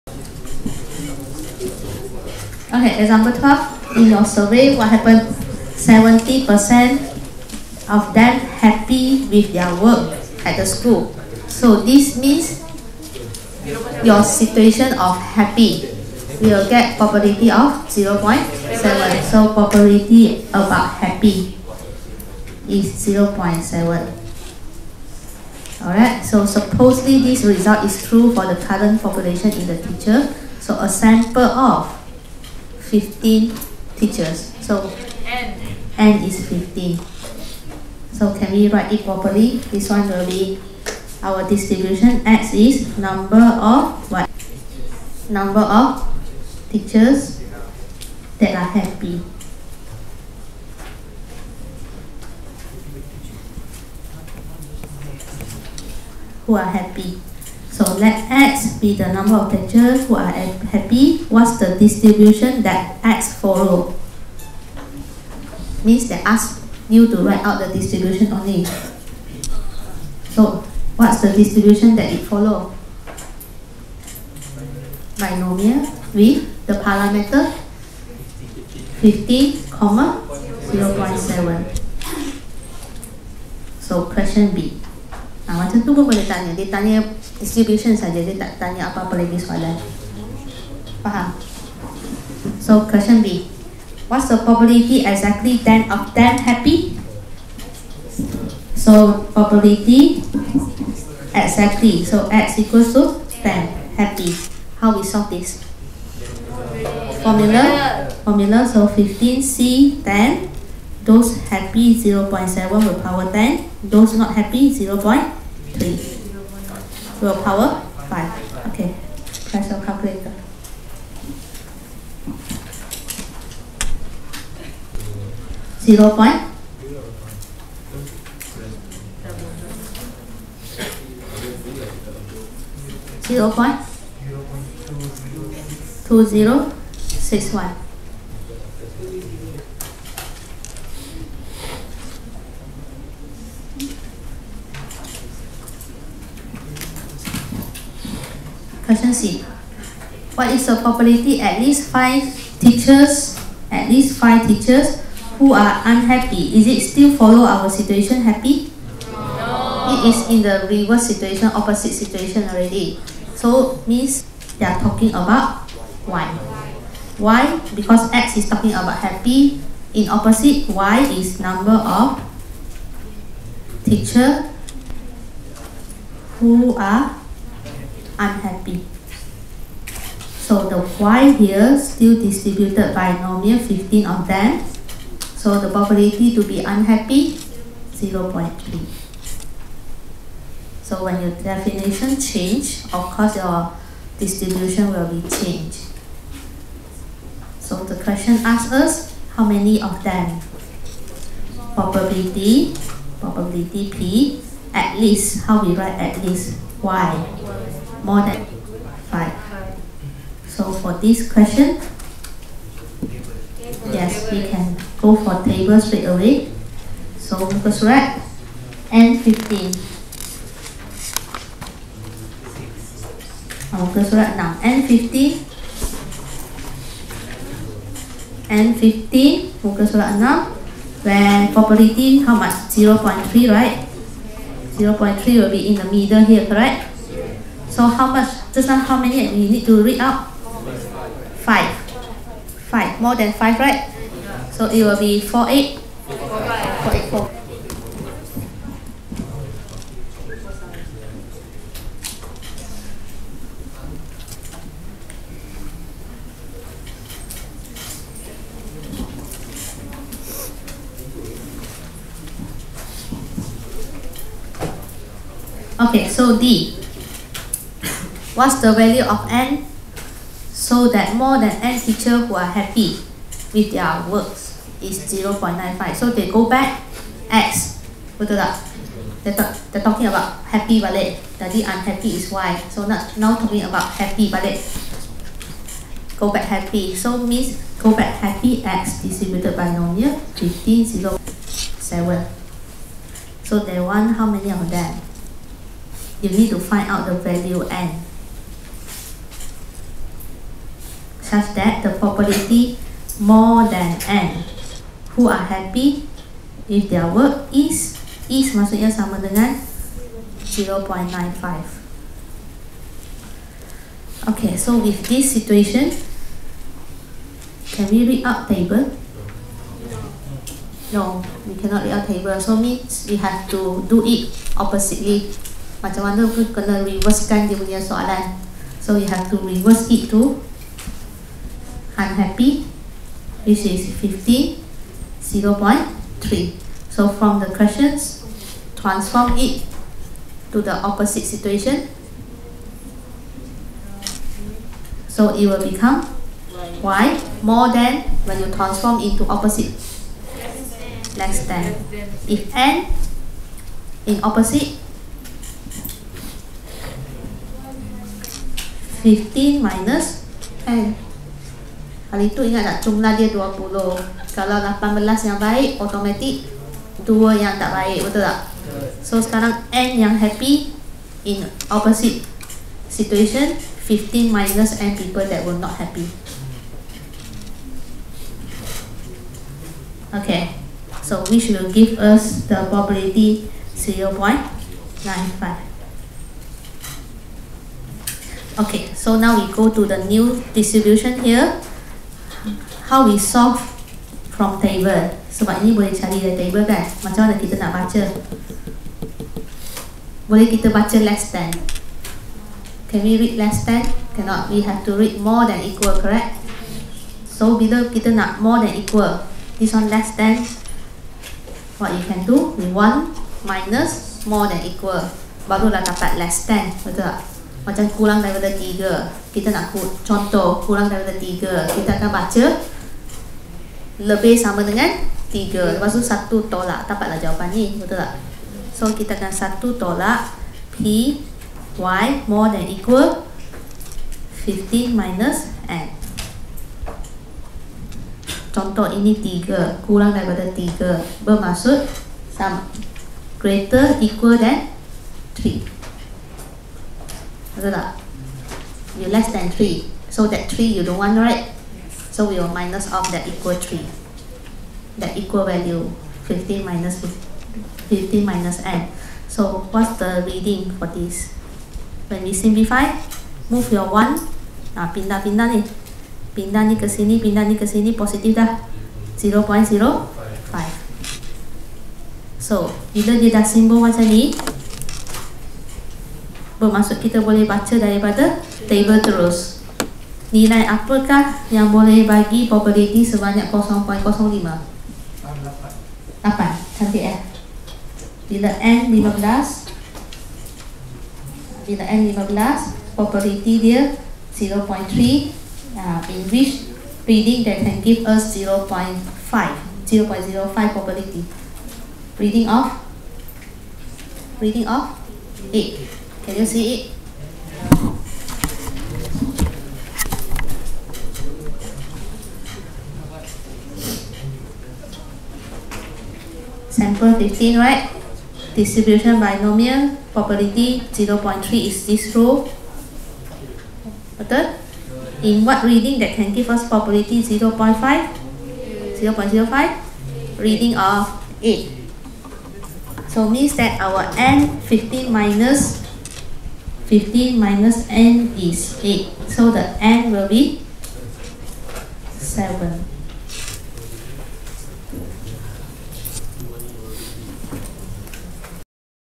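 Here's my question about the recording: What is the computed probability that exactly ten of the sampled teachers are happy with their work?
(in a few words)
0.2061.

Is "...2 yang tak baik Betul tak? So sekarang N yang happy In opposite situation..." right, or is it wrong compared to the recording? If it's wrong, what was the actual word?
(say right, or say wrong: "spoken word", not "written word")
right.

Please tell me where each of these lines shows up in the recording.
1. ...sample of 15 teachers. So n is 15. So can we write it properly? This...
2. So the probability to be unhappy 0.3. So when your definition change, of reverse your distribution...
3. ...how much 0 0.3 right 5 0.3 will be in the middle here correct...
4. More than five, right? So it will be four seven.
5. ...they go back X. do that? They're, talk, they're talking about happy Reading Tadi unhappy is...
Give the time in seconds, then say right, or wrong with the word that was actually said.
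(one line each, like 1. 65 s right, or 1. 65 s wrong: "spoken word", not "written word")
1. 30 s right
2. 185 s wrong: "course", not "reverse"
3. 232 s wrong: "0", not "5"
4. 242 s wrong: "eight", not "seven"
5. 276 s wrong: "That", not "Reading".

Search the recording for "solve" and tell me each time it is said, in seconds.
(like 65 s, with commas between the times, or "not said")
105 s, 393 s.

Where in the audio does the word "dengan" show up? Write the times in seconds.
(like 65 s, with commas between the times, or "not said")
309 s, 424 s.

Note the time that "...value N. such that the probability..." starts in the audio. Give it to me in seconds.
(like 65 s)
297 s.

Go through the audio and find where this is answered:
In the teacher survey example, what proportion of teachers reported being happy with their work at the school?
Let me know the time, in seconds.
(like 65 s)
5 s.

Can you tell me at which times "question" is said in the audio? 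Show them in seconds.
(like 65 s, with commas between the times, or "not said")
84 s, 92 s, 148 s, 198 s, 211 s, 337 s.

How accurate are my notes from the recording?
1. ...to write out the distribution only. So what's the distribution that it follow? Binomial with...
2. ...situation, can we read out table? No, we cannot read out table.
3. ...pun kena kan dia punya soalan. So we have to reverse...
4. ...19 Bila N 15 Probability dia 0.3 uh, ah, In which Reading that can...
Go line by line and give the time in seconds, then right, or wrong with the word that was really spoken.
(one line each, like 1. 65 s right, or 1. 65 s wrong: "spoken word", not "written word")
1. 67 s right
2. 315 s right
3. 326 s right
4. 488 s wrong: "15", not "19".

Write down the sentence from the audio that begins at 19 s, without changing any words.
So probability about happy is 0.7.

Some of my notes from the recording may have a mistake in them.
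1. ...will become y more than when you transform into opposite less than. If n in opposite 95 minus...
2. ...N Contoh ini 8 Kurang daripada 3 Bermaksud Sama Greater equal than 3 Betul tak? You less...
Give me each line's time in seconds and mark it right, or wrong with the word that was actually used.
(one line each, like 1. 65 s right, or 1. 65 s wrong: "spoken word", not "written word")
1. 345 s wrong: "15", not "95"
2. 435 s wrong: "3", not "8".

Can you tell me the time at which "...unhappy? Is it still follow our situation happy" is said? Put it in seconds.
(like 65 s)
155 s.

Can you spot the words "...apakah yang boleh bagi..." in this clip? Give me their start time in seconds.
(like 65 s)
480 s.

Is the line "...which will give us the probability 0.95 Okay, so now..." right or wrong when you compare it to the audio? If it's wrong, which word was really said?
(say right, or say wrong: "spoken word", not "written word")
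right.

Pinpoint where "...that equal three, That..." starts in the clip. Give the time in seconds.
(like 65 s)
453 s.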